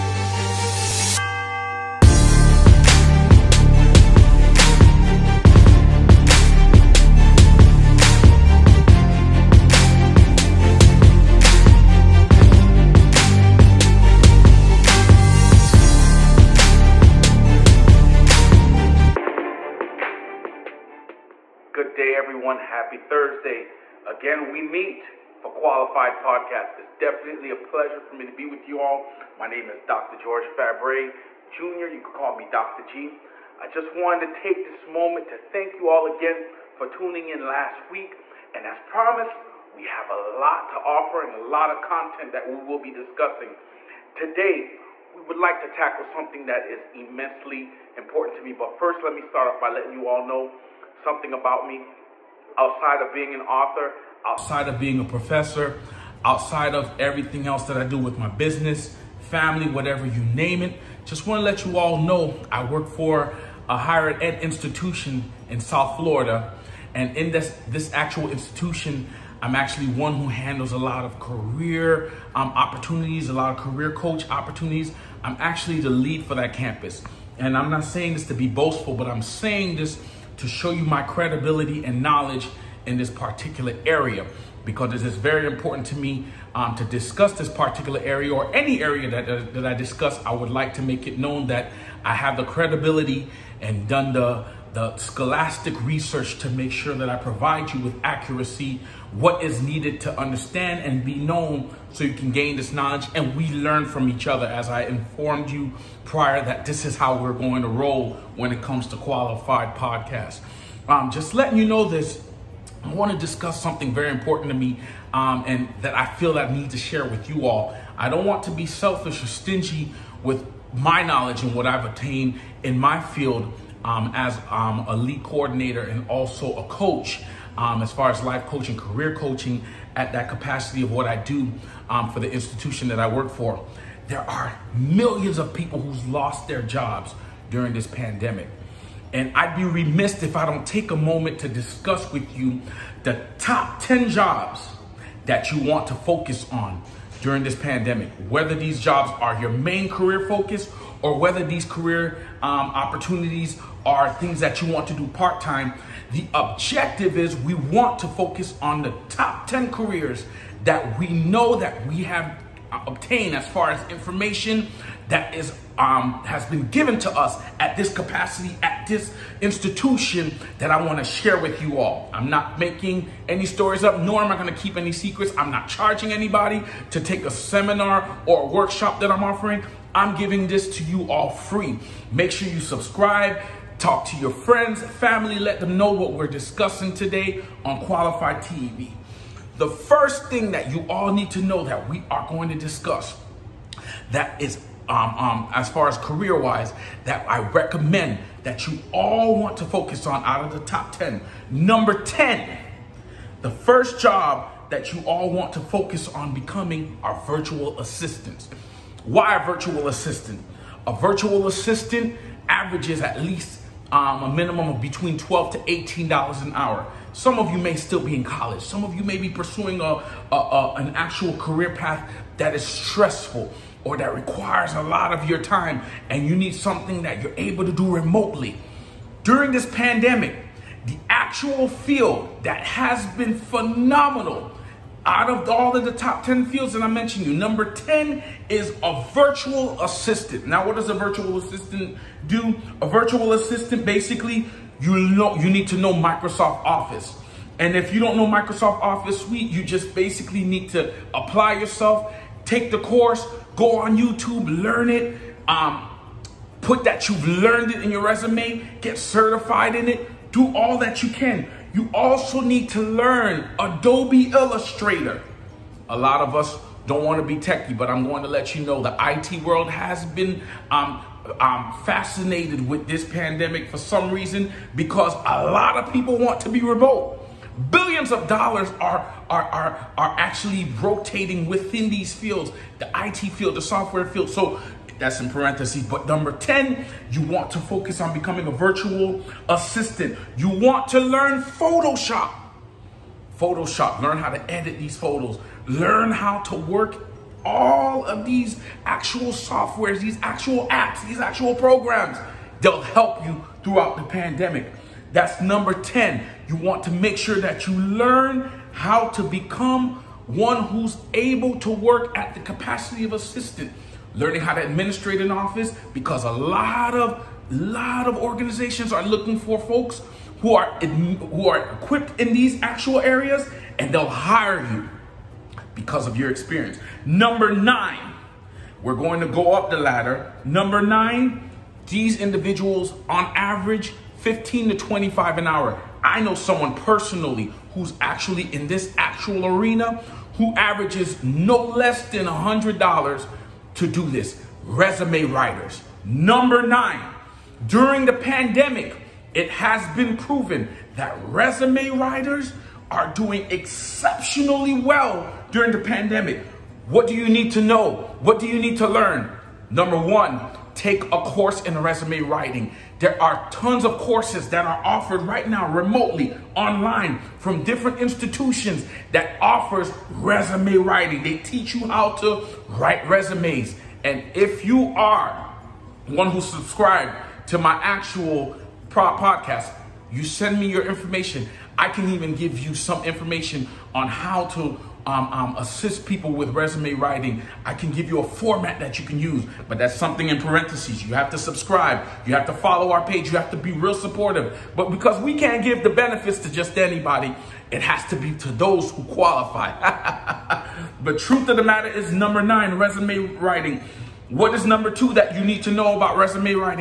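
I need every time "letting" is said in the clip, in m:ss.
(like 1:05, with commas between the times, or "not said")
0:49, 1:51.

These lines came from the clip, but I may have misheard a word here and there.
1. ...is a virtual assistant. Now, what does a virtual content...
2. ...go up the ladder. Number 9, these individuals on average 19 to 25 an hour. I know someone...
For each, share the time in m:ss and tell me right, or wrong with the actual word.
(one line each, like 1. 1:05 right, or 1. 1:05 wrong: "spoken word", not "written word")
1. 3:58 wrong: "assistant", not "content"
2. 5:29 wrong: "15", not "19".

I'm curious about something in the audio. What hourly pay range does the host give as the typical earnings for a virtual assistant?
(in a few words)
$12 to $18.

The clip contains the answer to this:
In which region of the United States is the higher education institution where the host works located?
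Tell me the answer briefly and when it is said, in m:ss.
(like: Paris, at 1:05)
South Florida, at 1:05.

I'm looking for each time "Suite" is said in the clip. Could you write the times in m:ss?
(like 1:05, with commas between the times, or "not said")
4:09.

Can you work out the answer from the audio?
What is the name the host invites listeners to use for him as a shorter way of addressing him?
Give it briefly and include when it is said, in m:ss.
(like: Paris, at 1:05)
Dr. G, at 0:32.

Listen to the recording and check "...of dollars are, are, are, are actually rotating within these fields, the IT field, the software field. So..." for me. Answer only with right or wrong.
right.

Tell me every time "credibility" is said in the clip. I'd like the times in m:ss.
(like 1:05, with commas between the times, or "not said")
1:21, 1:32.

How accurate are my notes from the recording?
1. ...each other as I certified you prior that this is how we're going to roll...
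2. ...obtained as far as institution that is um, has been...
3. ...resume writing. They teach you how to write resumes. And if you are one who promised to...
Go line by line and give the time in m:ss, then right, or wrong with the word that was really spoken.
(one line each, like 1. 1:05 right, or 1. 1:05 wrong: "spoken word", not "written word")
1. 1:44 wrong: "informed", not "certified"
2. 2:42 wrong: "information", not "institution"
3. 6:10 wrong: "subscribed", not "promised".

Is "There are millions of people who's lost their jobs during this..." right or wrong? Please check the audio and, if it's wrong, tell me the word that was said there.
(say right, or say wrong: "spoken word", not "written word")
right.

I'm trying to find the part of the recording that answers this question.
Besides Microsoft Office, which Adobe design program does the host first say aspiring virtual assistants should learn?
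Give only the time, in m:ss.
4:23.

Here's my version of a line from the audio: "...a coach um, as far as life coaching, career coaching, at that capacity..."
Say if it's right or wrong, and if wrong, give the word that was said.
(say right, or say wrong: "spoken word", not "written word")
right.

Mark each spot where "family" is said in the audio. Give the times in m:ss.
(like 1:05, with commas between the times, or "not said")
0:59, 3:04.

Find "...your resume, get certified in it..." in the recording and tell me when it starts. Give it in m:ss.
4:17.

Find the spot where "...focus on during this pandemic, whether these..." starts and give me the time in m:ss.
2:25.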